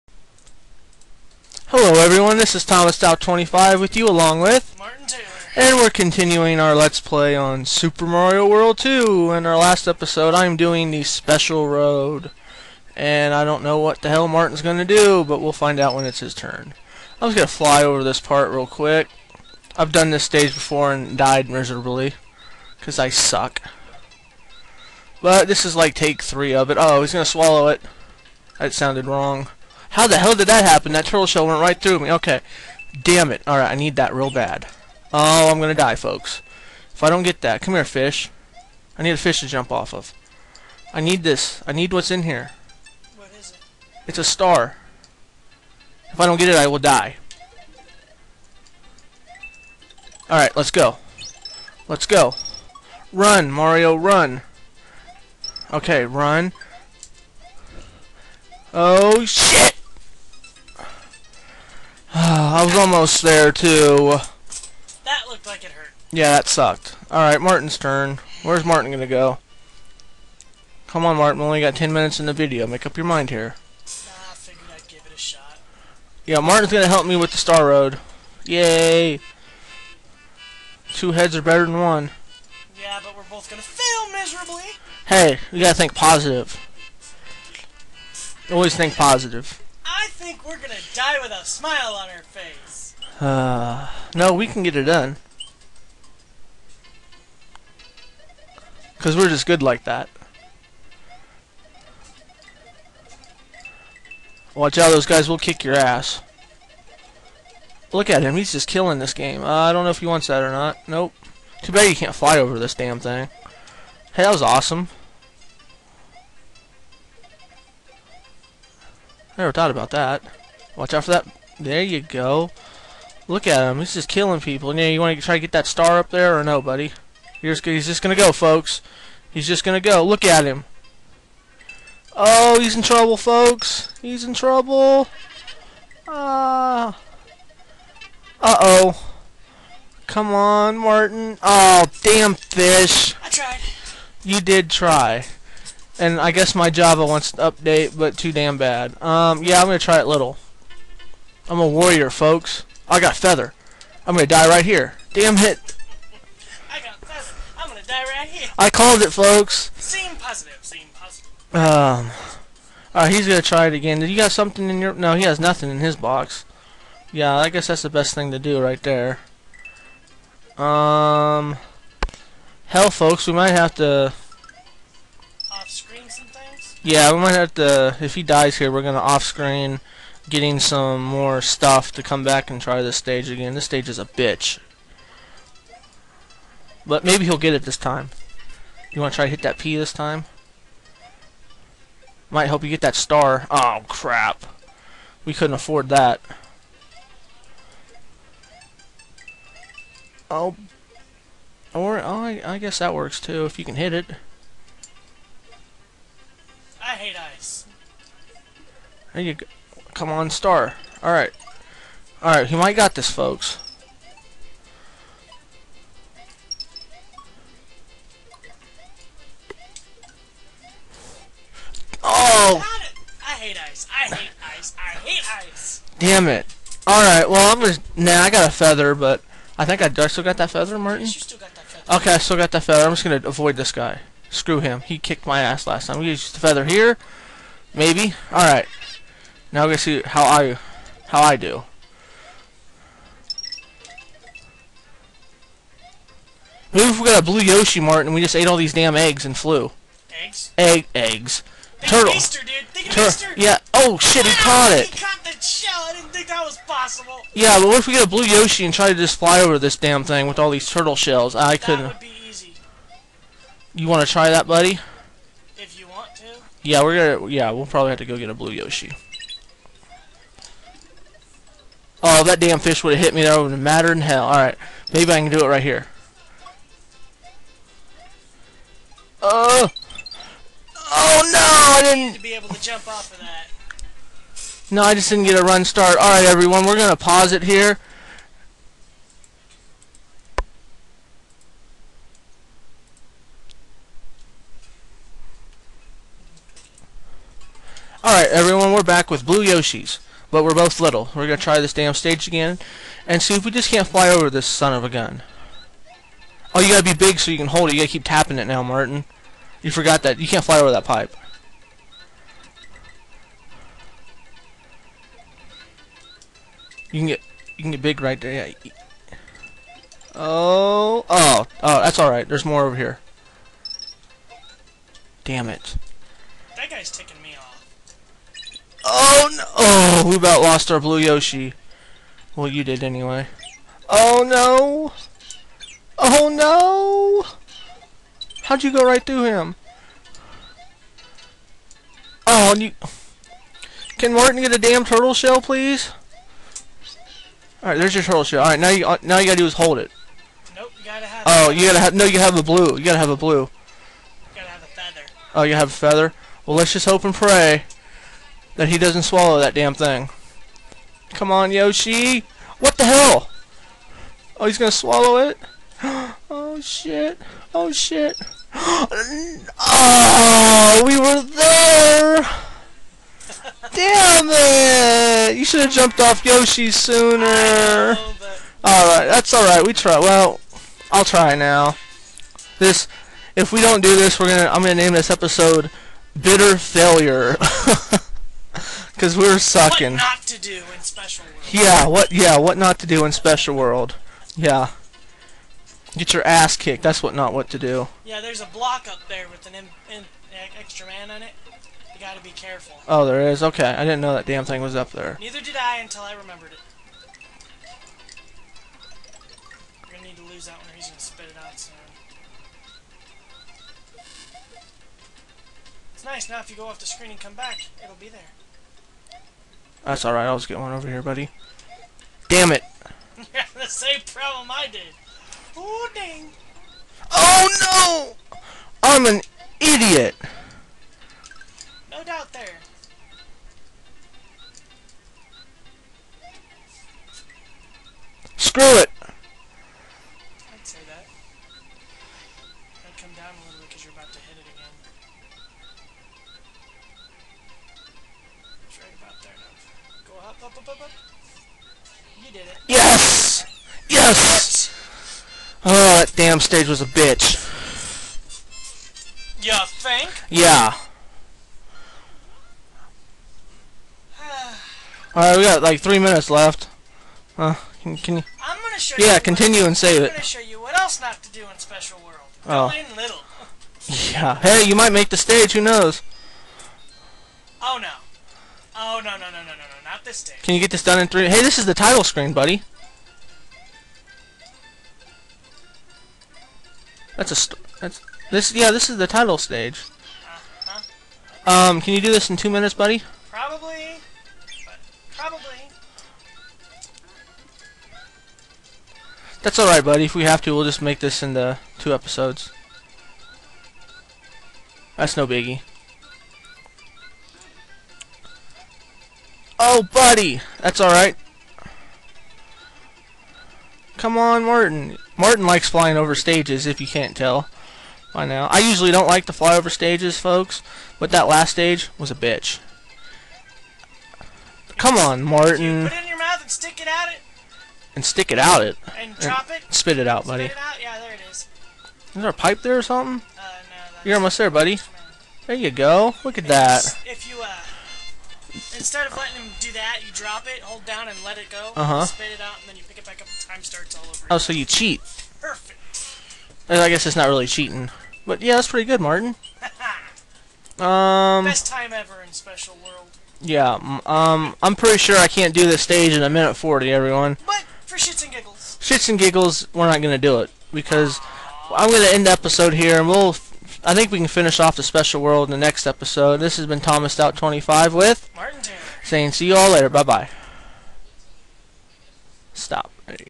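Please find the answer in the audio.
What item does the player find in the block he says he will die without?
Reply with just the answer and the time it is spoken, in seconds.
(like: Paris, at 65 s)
A star, at 44 s.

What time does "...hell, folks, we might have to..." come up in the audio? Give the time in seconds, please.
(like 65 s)
172 s.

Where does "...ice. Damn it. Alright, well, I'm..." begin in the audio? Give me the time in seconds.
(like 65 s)
225 s.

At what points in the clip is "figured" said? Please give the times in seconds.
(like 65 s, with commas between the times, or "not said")
74 s.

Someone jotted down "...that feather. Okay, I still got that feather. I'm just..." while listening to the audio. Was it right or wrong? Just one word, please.
right.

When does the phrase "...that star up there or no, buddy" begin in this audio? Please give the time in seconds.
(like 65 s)
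125 s.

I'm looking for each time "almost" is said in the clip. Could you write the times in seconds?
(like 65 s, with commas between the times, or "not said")
62 s, 534 s.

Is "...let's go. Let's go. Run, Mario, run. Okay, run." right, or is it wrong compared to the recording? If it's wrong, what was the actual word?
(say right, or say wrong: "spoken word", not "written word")
right.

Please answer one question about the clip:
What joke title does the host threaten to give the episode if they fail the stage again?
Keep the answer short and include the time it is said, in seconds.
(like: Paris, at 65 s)
Bitter Failure, at 386 s.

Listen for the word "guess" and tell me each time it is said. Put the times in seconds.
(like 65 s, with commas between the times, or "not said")
146 s, 167 s, 202 s, 546 s.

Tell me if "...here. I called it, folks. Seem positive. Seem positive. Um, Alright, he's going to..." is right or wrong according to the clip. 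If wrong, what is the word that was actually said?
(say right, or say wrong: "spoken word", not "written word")
right.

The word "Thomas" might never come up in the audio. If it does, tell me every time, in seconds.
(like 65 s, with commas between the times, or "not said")
2 s, 566 s.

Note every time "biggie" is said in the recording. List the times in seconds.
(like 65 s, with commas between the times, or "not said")
505 s.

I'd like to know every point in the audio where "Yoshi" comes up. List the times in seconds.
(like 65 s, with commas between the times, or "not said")
247 s, 258 s, 268 s, 299 s, 330 s, 361 s, 376 s.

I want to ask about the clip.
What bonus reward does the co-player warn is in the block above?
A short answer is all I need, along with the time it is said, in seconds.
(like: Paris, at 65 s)
An extra man, at 400 s.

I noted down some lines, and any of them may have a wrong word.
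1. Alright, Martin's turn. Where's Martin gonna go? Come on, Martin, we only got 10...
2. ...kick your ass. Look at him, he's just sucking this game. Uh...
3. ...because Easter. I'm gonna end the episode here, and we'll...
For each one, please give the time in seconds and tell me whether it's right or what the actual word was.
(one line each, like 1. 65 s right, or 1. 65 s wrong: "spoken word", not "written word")
1. 67 s right
2. 105 s wrong: "killing", not "sucking"
3. 560 s wrong: "Aww", not "Easter".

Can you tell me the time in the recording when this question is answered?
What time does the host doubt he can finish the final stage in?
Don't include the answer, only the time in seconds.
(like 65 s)
556 s.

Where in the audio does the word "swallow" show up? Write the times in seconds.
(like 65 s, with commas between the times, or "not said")
27 s, 359 s, 364 s.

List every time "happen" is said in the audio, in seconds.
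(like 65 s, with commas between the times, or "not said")
30 s.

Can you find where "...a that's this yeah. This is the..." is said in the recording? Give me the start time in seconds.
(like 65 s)
487 s.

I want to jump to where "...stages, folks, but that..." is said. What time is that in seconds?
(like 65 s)
519 s.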